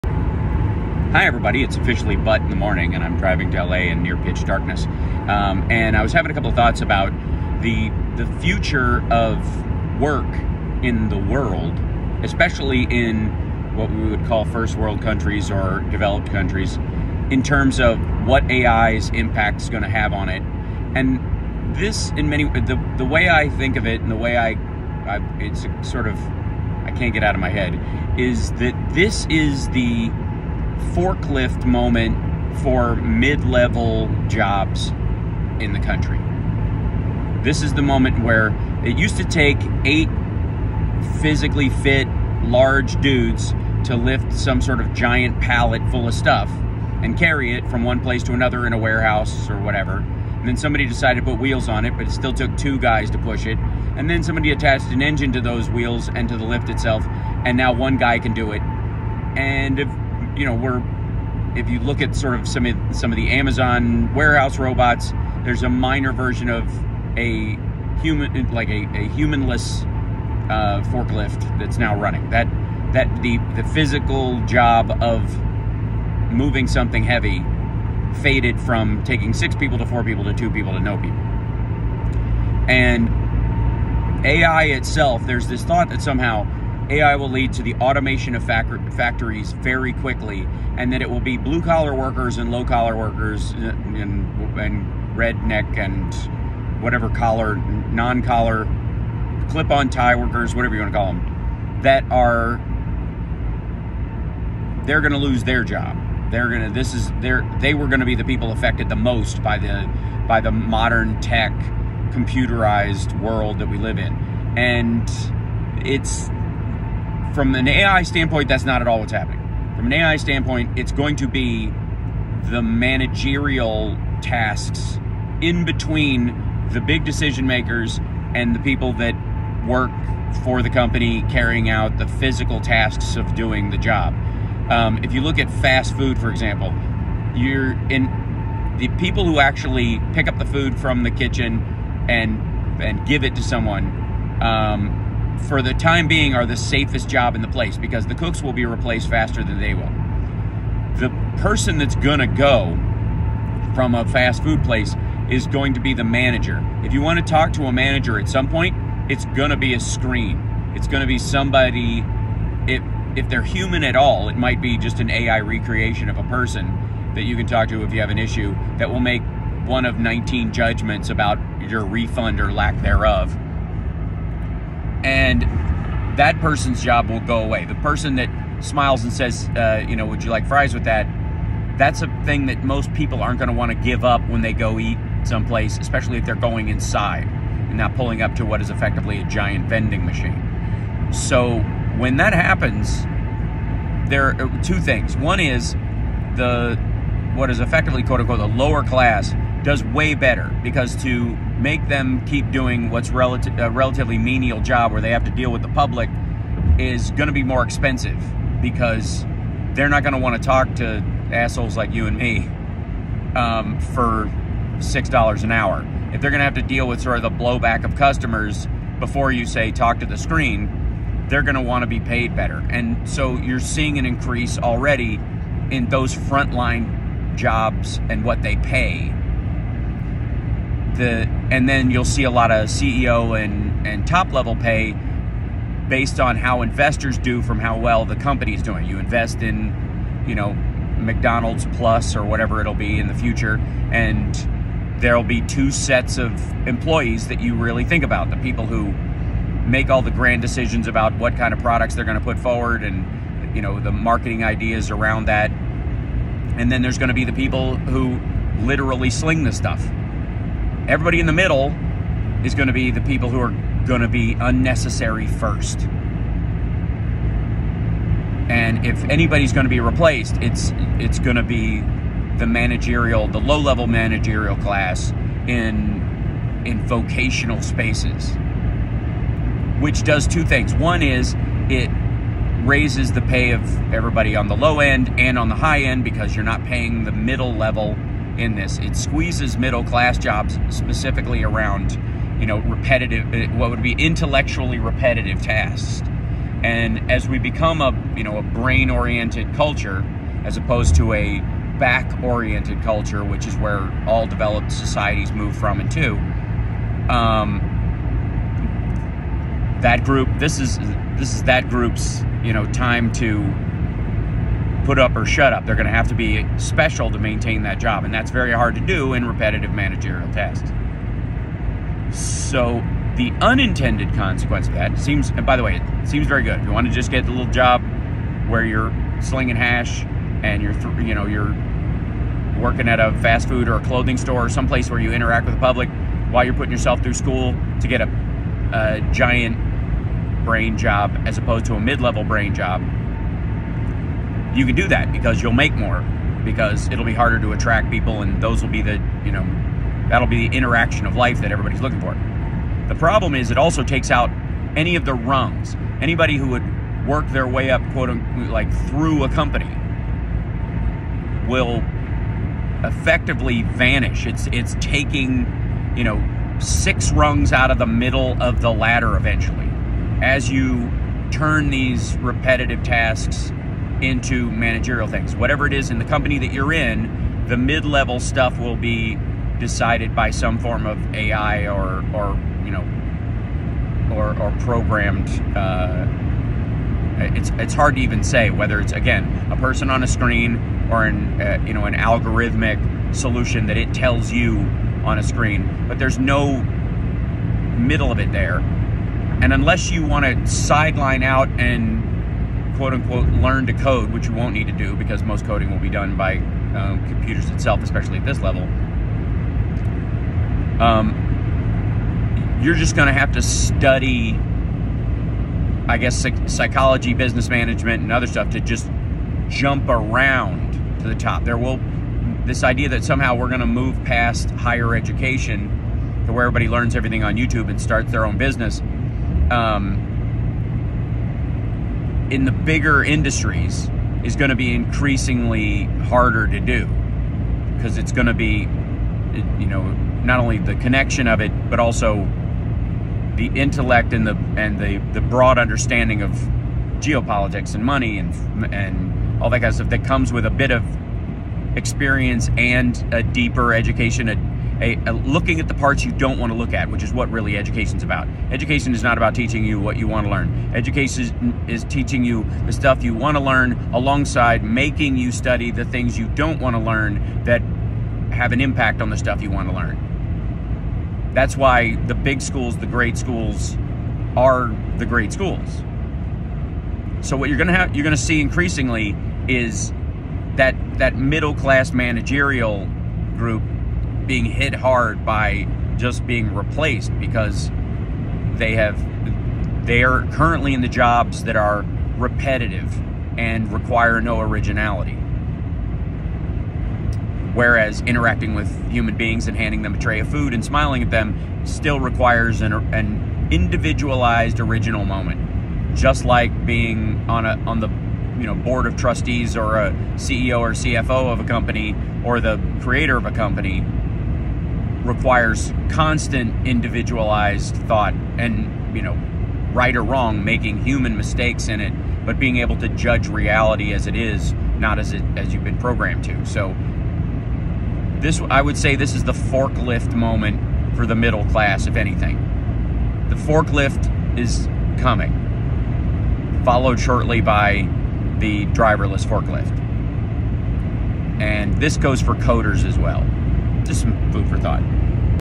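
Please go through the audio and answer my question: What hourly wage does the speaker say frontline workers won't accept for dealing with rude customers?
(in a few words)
6 dollars an hour.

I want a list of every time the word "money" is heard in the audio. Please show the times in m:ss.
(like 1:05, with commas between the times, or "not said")
7:27.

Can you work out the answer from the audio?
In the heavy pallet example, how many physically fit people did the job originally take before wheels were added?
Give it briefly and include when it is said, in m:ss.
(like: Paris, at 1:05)
8, at 0:39.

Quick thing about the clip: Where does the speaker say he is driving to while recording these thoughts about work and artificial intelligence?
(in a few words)
LA.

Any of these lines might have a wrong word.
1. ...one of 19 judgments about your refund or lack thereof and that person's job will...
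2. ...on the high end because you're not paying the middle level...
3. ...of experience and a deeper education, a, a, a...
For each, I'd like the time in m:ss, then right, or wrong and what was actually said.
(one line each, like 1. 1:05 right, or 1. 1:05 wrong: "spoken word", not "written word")
1. 2:49 right
2. 4:45 right
3. 7:30 right.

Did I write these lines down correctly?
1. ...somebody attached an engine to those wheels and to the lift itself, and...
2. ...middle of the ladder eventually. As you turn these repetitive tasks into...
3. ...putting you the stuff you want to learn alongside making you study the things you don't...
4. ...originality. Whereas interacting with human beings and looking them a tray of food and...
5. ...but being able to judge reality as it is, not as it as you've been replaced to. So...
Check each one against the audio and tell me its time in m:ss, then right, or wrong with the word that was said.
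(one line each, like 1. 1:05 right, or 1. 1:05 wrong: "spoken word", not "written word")
1. 0:54 right
2. 6:07 right
3. 7:41 wrong: "teaching", not "putting"
4. 8:14 wrong: "handing", not "looking"
5. 8:42 wrong: "programmed", not "replaced".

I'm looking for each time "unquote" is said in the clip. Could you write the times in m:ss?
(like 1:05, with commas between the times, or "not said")
3:18, 5:58, 6:42.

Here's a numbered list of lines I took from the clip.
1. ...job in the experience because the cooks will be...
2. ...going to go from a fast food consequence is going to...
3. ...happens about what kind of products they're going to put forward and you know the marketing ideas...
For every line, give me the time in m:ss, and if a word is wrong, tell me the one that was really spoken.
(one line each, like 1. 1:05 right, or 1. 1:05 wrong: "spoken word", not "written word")
1. 2:27 wrong: "place", not "experience"
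2. 2:31 wrong: "place", not "consequence"
3. 4:10 wrong: "decisions", not "happens".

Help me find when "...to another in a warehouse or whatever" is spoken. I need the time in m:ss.
0:48.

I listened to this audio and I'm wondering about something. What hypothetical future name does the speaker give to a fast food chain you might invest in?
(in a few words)
McDonald's Plus.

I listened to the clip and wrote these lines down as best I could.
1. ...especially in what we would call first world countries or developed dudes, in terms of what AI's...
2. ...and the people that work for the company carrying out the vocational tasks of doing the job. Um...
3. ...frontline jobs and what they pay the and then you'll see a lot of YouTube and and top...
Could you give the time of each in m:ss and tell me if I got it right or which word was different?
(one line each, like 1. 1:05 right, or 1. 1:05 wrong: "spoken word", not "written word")
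1. 0:12 wrong: "countries", not "dudes"
2. 2:08 wrong: "physical", not "vocational"
3. 3:46 wrong: "CEO", not "YouTube".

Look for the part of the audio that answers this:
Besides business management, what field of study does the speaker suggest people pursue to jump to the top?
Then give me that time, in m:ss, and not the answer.
6:56.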